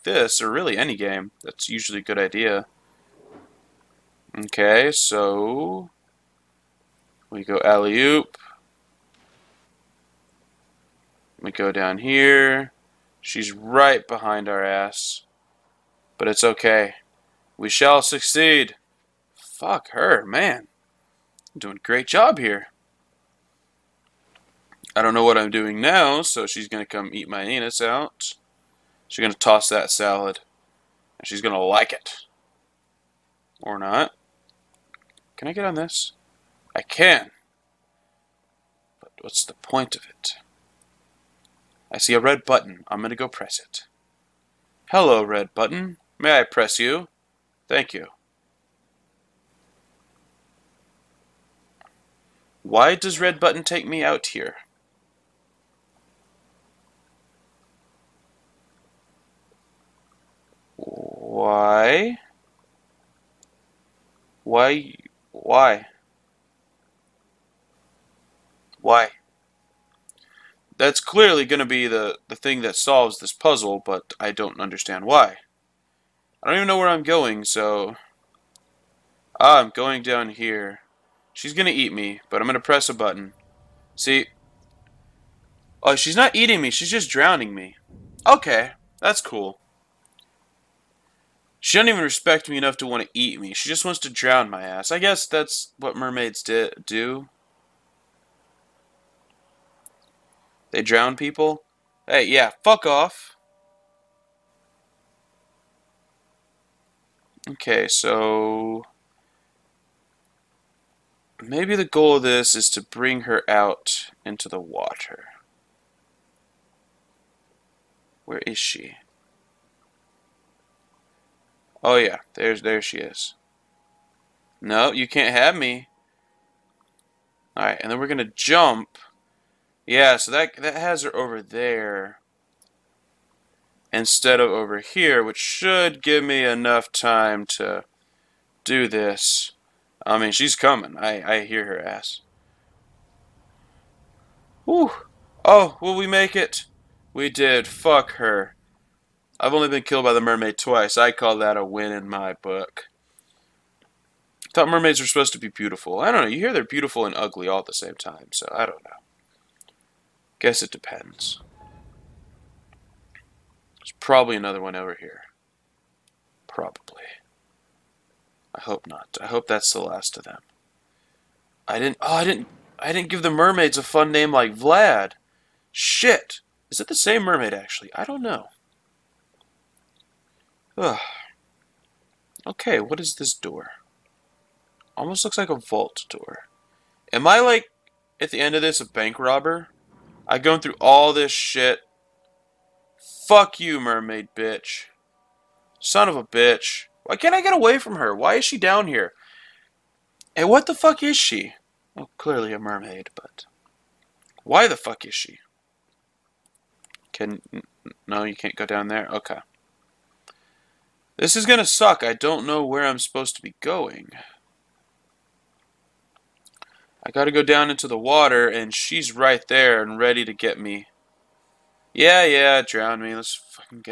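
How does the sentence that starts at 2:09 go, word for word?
Yeah, so that that has her over there.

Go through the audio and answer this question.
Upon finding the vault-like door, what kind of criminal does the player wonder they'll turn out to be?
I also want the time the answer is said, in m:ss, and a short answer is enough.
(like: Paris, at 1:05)
Bank robber, at 3:08.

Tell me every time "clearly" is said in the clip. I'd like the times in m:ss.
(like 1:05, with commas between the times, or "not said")
1:10, 3:22.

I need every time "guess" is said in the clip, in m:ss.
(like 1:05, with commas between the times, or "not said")
1:34, 2:40.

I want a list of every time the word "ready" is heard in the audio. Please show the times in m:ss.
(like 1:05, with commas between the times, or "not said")
3:39.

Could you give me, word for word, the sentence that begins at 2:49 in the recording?
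I hope that's the last of them.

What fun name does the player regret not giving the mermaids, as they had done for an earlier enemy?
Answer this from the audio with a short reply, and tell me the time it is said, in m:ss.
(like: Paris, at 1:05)
Vlad, at 2:54.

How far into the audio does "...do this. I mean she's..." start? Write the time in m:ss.
2:18.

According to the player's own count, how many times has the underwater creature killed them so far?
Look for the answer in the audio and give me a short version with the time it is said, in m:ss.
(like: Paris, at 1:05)
2, at 2:30.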